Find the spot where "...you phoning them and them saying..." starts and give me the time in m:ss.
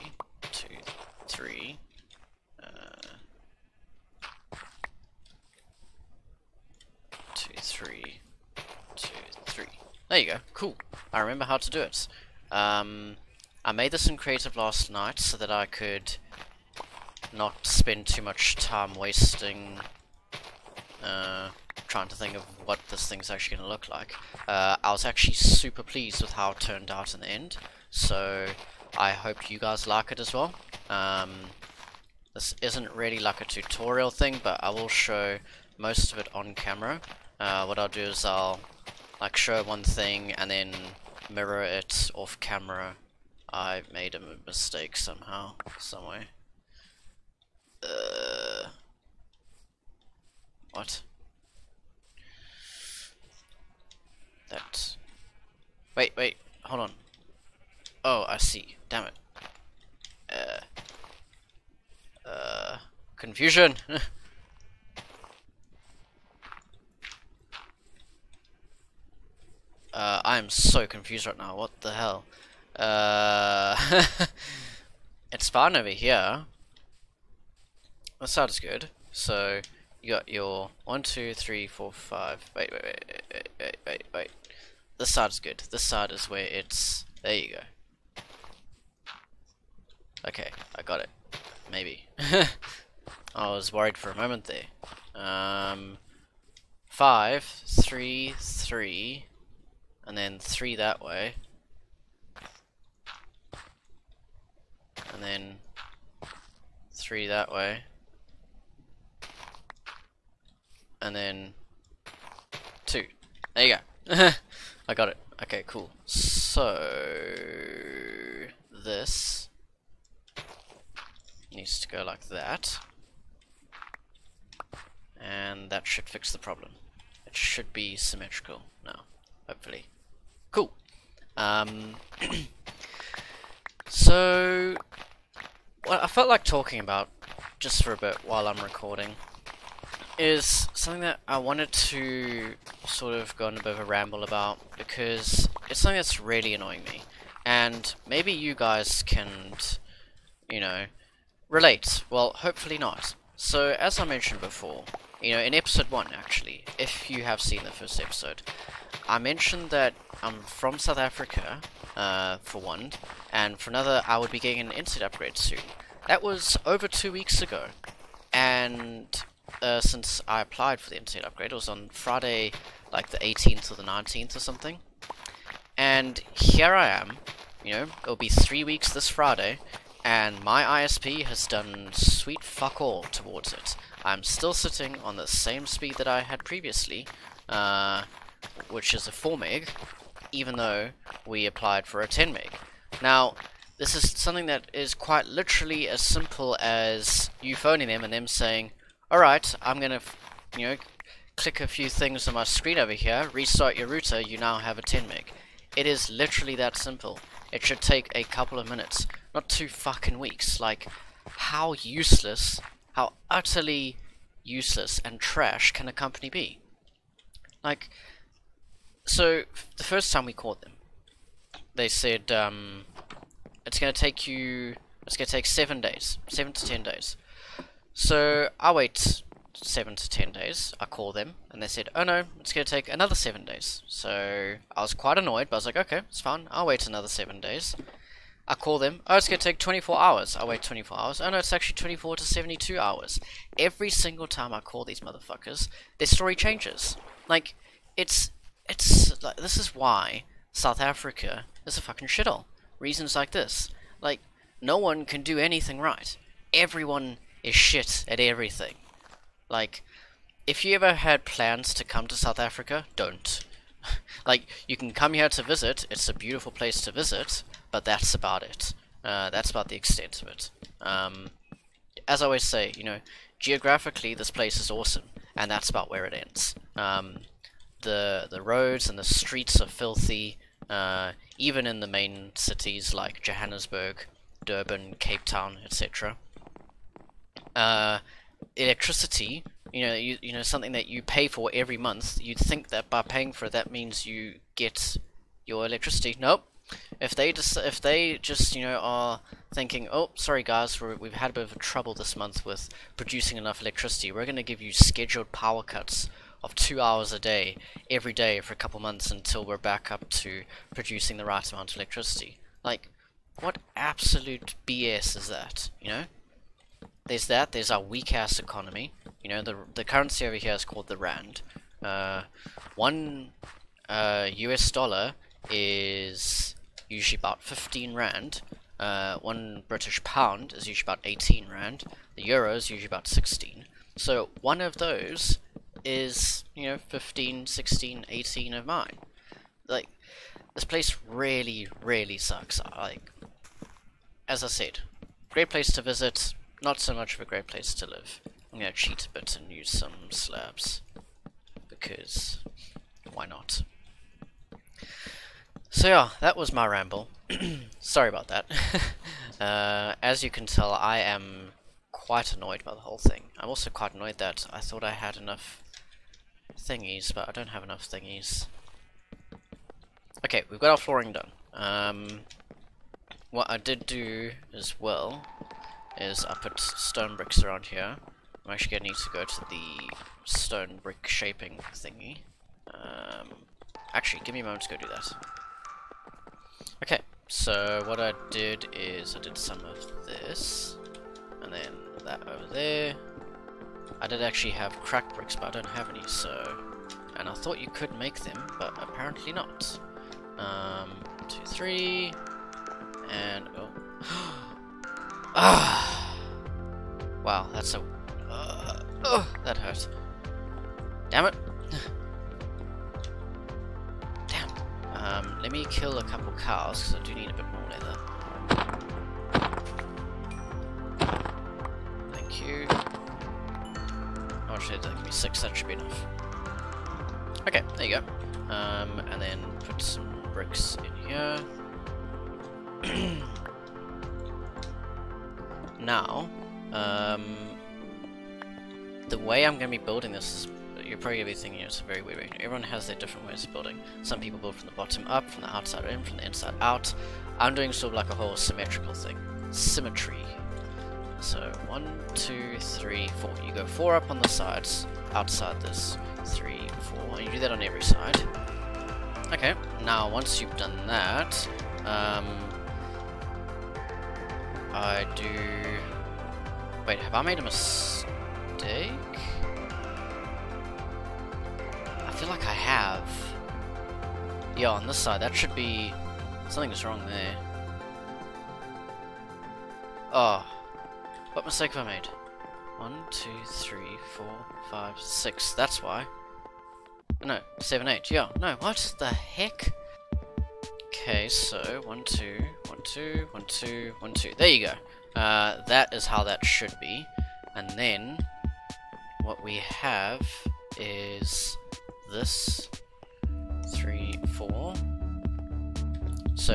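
3:17.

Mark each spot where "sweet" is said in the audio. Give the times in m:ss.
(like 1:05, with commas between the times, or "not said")
3:01.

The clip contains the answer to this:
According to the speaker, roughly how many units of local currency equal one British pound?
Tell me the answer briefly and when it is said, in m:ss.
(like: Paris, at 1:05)
18, at 5:31.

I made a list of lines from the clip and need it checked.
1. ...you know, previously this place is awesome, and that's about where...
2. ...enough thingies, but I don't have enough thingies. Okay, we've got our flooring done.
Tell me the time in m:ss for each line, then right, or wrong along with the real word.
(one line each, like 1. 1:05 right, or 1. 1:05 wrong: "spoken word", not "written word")
1. 4:32 wrong: "geographically", not "previously"
2. 6:05 right.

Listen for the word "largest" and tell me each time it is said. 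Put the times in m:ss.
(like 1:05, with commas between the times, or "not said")
not said.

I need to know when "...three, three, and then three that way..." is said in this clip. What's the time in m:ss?
1:37.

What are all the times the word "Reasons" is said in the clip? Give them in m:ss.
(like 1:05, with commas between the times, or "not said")
4:12.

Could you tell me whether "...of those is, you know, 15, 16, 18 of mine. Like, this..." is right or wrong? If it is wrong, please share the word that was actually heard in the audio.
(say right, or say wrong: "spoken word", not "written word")
right.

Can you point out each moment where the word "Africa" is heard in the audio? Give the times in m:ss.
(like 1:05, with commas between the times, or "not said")
2:40, 4:10, 4:22.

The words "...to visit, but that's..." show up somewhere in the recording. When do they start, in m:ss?
4:26.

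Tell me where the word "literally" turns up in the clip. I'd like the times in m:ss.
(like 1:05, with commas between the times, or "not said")
3:15, 3:26.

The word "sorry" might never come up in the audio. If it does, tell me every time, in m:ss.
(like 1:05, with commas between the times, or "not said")
5:00, 5:57.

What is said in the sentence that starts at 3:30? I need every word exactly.
Like, how useless, how utterly useless and trash can a company be?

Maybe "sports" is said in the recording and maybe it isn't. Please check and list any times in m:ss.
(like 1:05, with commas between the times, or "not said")
not said.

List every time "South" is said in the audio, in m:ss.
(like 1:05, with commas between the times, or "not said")
2:40, 4:10, 4:22.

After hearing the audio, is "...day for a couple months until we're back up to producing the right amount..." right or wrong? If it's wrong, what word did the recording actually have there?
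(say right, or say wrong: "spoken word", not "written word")
right.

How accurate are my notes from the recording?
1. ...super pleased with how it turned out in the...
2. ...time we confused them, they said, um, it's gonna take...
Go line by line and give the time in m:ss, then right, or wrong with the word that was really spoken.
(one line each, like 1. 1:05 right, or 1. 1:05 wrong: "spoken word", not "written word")
1. 0:25 right
2. 3:40 wrong: "called", not "confused".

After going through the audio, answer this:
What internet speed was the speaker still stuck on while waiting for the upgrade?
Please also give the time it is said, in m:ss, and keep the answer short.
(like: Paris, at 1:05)
4 meg, at 3:09.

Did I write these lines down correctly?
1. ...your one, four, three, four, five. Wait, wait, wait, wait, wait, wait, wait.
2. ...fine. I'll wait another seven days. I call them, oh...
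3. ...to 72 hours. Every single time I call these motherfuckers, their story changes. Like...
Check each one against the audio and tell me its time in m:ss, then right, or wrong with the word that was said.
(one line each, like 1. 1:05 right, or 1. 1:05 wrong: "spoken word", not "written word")
1. 1:20 wrong: "two", not "four"
2. 3:56 right
3. 4:02 right.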